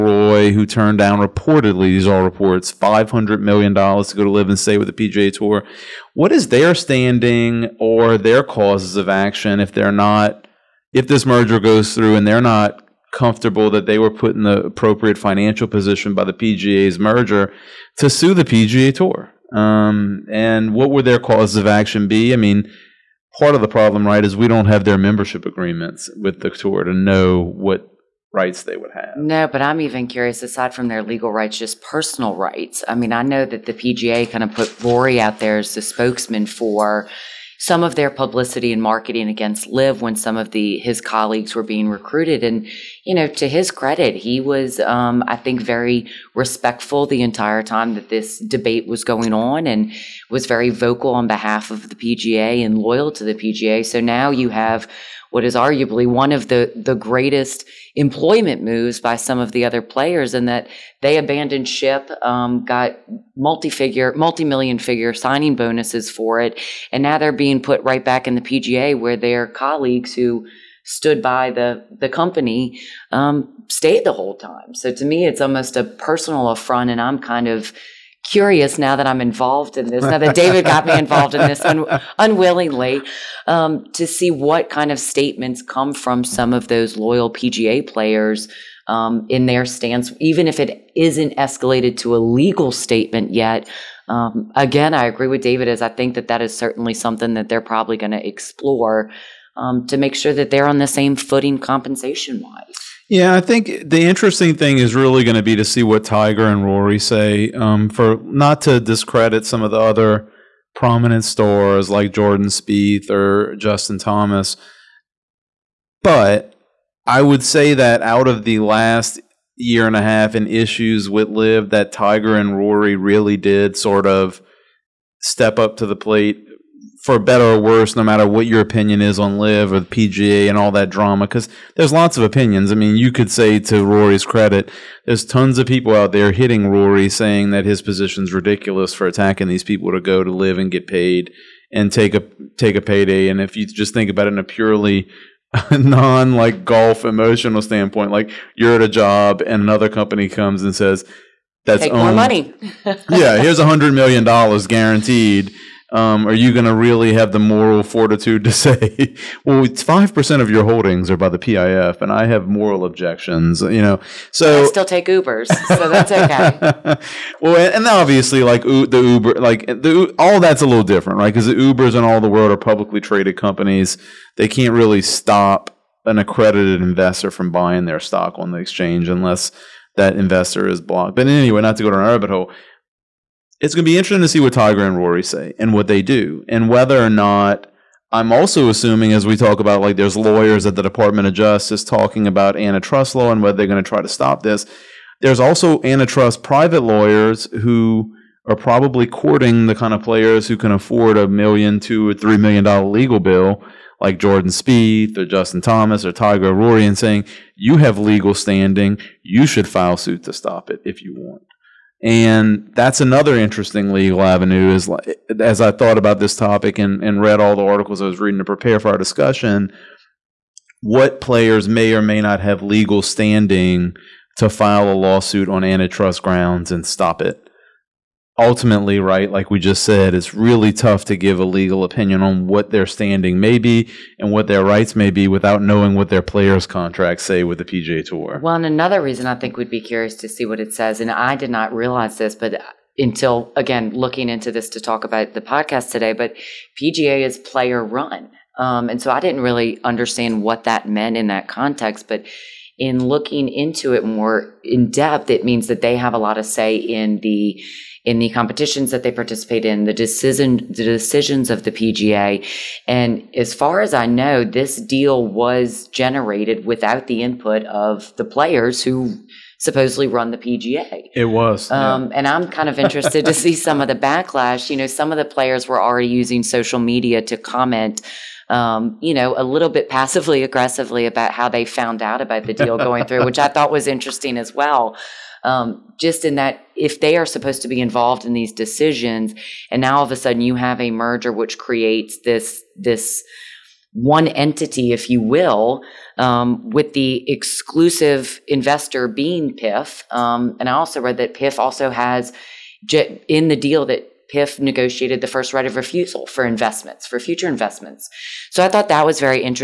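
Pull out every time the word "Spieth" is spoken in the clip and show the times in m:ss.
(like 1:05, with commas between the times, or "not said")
1:52, 3:24.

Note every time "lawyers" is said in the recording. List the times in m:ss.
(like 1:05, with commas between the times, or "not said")
3:10, 3:16.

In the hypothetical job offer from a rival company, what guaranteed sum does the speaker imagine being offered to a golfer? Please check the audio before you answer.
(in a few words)
$100 million.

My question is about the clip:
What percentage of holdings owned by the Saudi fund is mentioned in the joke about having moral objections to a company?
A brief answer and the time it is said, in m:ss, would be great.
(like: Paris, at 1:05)
5%, at 2:39.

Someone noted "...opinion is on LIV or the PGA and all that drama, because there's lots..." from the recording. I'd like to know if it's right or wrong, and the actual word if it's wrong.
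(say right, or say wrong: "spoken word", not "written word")
right.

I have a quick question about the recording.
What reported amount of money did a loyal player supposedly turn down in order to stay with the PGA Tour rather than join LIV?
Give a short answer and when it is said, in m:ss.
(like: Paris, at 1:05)
$500 million, at 0:02.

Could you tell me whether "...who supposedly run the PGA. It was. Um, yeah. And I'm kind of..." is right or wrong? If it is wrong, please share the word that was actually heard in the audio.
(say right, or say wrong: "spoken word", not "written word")
right.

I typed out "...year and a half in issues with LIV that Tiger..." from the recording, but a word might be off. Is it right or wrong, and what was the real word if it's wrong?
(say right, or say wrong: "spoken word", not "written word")
right.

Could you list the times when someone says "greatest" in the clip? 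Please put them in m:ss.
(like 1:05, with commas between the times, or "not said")
0:56.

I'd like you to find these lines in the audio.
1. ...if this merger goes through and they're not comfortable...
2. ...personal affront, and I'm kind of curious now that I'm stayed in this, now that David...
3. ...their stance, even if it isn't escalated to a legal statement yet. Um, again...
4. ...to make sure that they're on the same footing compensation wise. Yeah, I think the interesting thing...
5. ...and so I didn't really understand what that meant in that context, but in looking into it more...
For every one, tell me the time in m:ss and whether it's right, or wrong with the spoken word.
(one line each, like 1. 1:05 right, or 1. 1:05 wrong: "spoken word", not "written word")
1. 0:10 right
2. 1:15 wrong: "involved", not "stayed"
3. 1:29 right
4. 1:39 right
5. 4:08 right.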